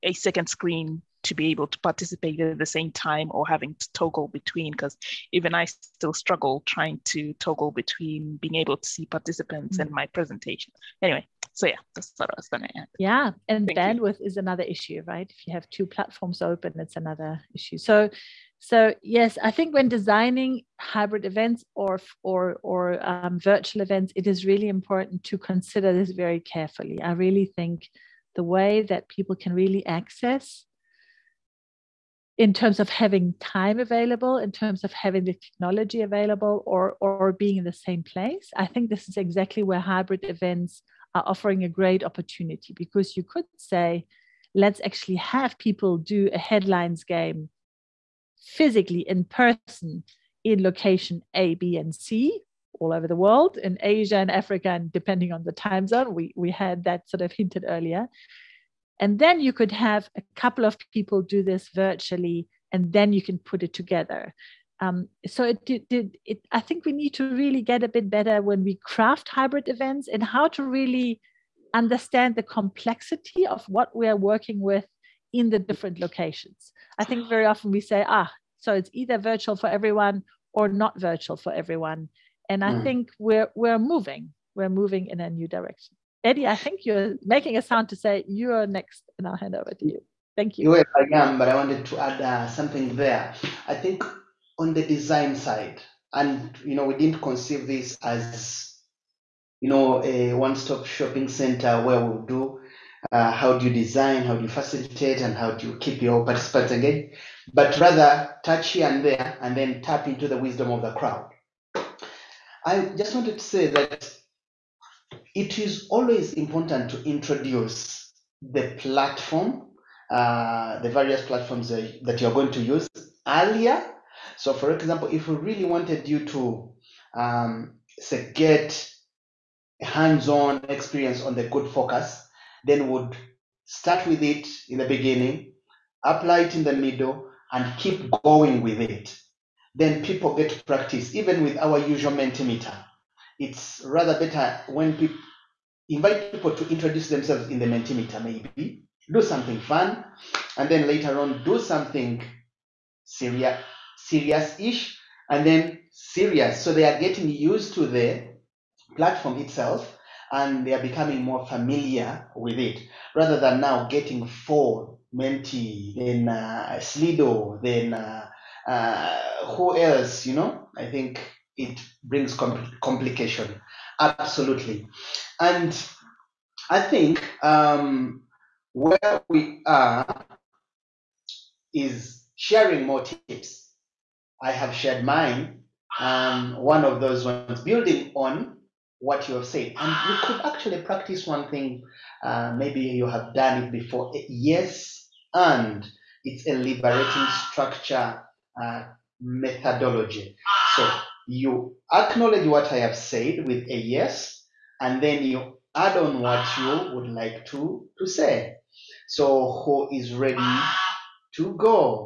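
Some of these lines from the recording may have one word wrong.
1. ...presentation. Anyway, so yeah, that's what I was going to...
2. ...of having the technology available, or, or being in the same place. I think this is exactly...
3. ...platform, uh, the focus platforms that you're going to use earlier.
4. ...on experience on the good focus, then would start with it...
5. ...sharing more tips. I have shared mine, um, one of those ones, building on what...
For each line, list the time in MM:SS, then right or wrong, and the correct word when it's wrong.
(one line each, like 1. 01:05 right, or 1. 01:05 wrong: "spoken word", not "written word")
1. 00:10 right
2. 00:34 right
3. 01:58 wrong: "various", not "focus"
4. 02:10 right
5. 03:02 right.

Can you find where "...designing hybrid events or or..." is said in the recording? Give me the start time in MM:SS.
00:19.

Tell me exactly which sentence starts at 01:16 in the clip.
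I think very often we say, ah, so it's either virtual for everyone or not virtual for everyone.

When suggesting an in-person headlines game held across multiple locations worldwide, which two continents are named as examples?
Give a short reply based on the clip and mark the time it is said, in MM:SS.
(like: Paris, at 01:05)
Asia and Africa, at 00:53.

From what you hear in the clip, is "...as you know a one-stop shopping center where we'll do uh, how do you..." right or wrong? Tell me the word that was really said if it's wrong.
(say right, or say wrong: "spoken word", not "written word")
right.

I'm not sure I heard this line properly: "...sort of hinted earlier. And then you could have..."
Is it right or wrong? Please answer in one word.
right.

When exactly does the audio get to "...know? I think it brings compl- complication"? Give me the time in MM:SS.
02:50.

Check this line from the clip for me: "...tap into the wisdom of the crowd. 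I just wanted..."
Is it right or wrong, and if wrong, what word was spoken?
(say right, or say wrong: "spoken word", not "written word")
right.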